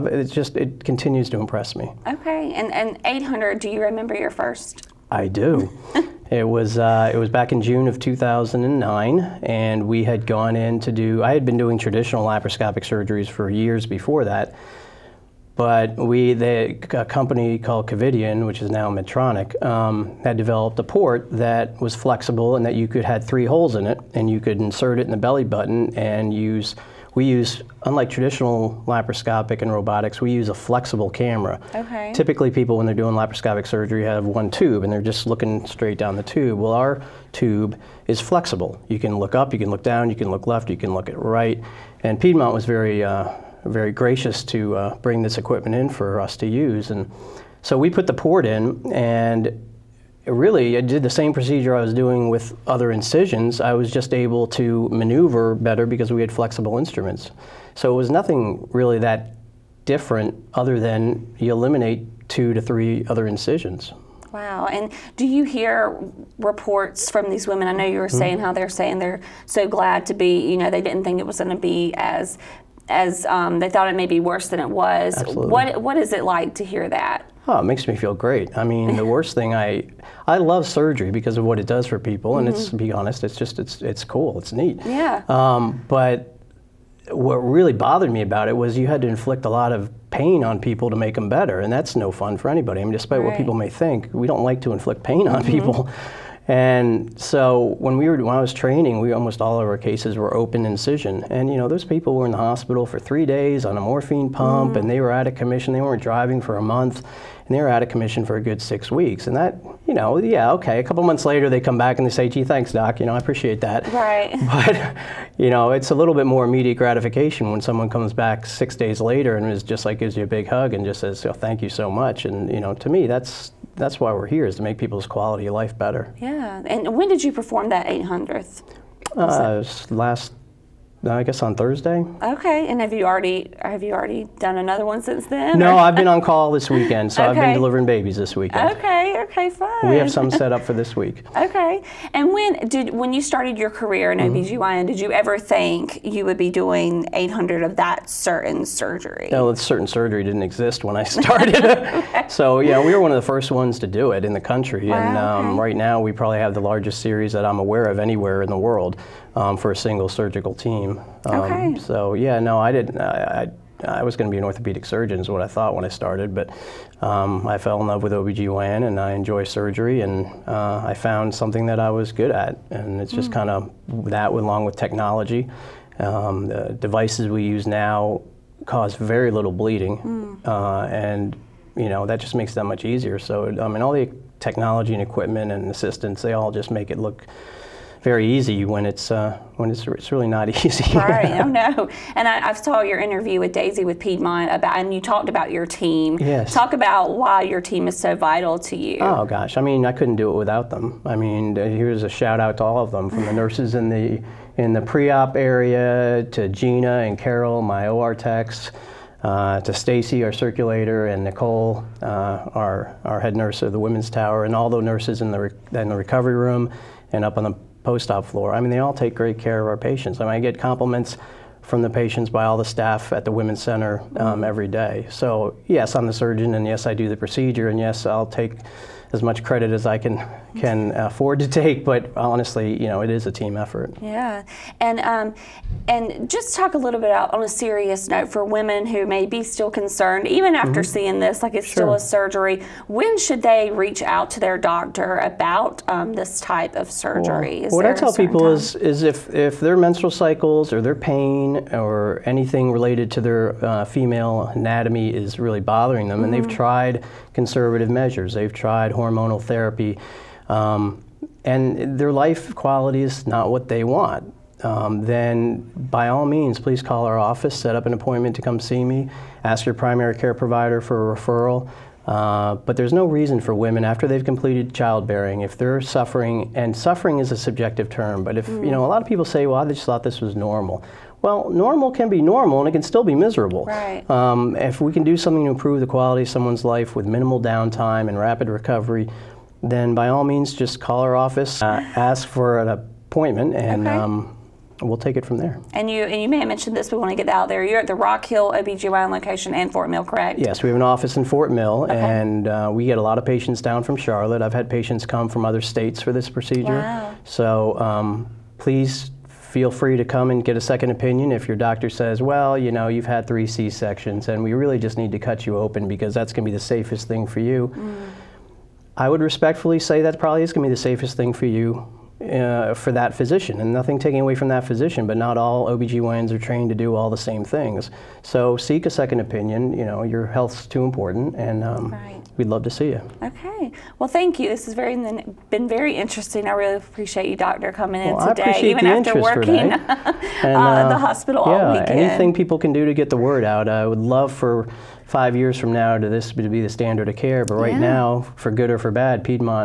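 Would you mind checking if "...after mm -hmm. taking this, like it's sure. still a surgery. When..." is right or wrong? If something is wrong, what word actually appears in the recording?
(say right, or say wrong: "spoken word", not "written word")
wrong: "seeing", not "taking".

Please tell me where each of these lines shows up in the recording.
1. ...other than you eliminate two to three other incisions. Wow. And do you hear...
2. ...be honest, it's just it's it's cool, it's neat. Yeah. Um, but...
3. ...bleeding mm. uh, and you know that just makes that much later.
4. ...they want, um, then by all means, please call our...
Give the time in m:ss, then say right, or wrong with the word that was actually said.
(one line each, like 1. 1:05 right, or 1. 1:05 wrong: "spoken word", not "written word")
1. 1:00 right
2. 1:22 right
3. 2:59 wrong: "easier", not "later"
4. 4:23 right.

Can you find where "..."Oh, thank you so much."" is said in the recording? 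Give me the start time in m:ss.
2:01.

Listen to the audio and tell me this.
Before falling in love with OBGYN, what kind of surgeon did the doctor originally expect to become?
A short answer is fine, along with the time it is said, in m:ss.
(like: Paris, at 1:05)
Orthopedic surgeon, at 2:44.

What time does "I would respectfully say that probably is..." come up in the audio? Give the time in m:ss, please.
5:18.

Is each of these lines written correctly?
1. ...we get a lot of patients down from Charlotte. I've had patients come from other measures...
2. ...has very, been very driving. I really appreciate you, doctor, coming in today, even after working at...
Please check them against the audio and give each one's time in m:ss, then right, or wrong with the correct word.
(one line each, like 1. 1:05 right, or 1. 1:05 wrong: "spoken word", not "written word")
1. 5:02 wrong: "states", not "measures"
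2. 5:34 wrong: "interesting", not "driving".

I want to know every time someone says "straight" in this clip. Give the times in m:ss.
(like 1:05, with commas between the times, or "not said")
0:35.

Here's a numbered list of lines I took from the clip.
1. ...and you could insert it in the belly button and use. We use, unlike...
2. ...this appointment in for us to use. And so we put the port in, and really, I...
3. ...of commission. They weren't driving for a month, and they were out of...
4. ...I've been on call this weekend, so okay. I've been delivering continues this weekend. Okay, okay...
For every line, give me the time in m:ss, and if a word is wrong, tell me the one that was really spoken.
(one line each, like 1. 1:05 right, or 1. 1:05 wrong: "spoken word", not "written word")
1. 0:24 right
2. 0:45 wrong: "equipment", not "appointment"
3. 1:45 right
4. 2:15 wrong: "babies", not "continues".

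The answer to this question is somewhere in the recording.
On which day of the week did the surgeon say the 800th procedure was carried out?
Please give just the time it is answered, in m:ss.
2:11.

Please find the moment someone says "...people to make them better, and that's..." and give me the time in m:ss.
1:30.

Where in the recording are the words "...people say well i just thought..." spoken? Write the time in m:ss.
4:39.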